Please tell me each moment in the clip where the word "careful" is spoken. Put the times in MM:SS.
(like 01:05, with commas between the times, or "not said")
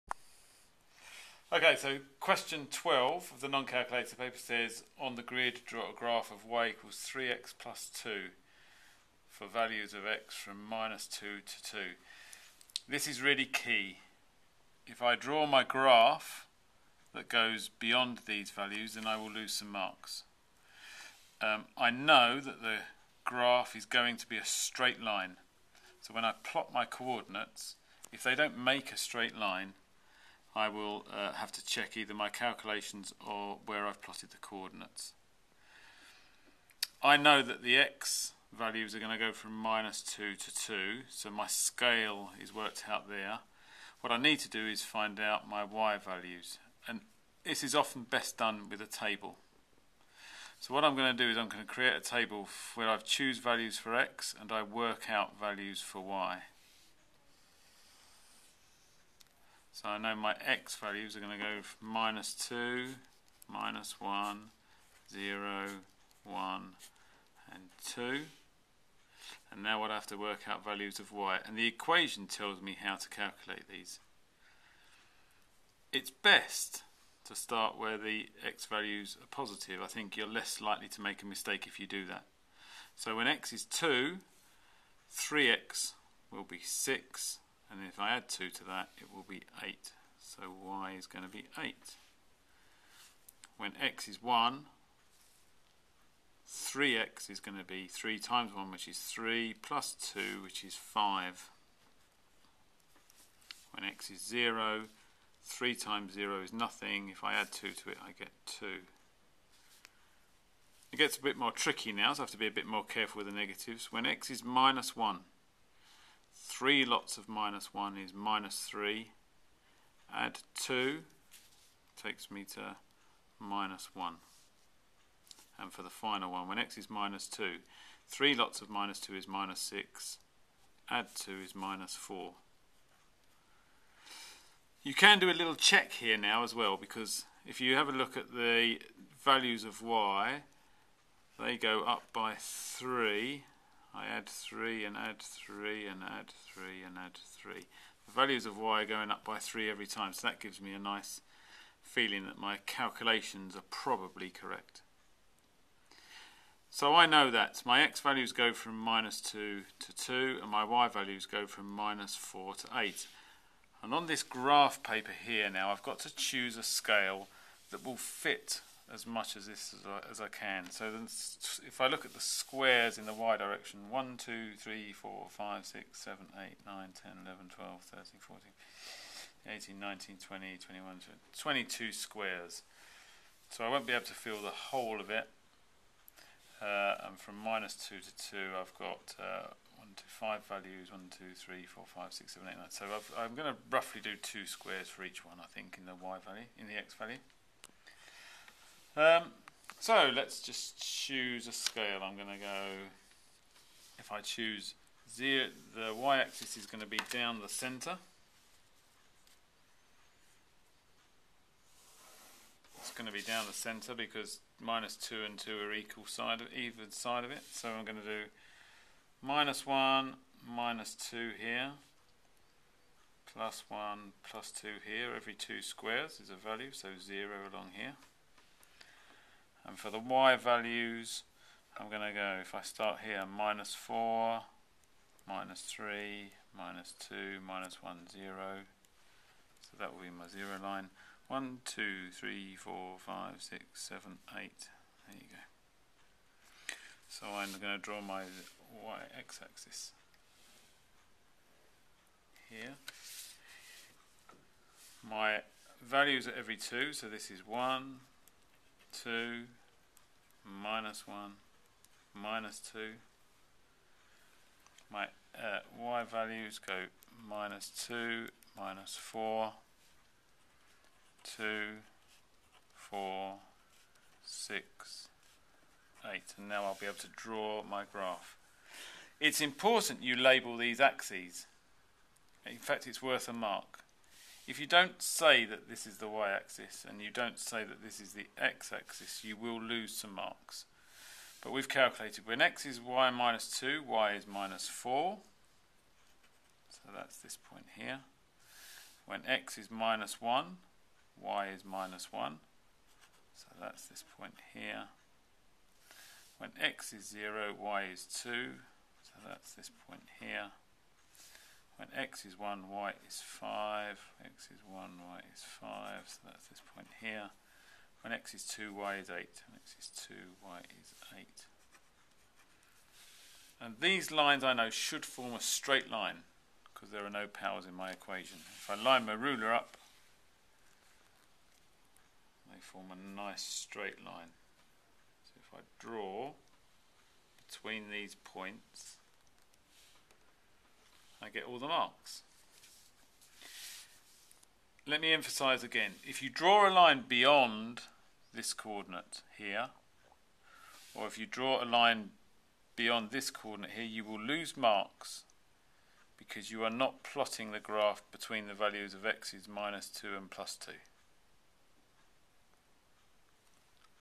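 01:52.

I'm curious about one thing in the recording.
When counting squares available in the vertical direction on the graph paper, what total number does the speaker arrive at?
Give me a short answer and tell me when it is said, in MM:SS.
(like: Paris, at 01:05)
22, at 03:01.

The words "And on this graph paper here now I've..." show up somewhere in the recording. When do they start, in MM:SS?
02:43.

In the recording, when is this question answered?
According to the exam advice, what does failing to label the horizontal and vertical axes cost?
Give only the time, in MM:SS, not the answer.
04:43.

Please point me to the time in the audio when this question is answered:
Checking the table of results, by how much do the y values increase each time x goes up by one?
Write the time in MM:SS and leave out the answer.
02:21.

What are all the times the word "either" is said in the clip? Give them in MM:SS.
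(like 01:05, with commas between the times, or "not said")
00:31, 03:36.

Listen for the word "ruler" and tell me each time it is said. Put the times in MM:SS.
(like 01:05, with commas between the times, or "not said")
05:29.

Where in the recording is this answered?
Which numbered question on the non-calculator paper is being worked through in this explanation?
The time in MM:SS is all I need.
00:02.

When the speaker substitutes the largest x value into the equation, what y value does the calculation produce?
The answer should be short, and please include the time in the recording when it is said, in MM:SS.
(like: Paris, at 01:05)
8, at 01:28.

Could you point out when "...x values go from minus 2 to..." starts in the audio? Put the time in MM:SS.
02:37.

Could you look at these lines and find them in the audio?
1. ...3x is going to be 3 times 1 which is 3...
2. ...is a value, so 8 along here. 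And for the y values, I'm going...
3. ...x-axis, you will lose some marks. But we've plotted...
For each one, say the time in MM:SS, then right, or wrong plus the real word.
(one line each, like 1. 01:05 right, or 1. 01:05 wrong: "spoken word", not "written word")
1. 01:36 right
2. 03:46 wrong: "0", not "8"
3. 04:48 wrong: "calculated", not "plotted".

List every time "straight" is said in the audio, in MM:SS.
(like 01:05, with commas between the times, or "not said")
00:24, 00:28, 05:25, 05:33.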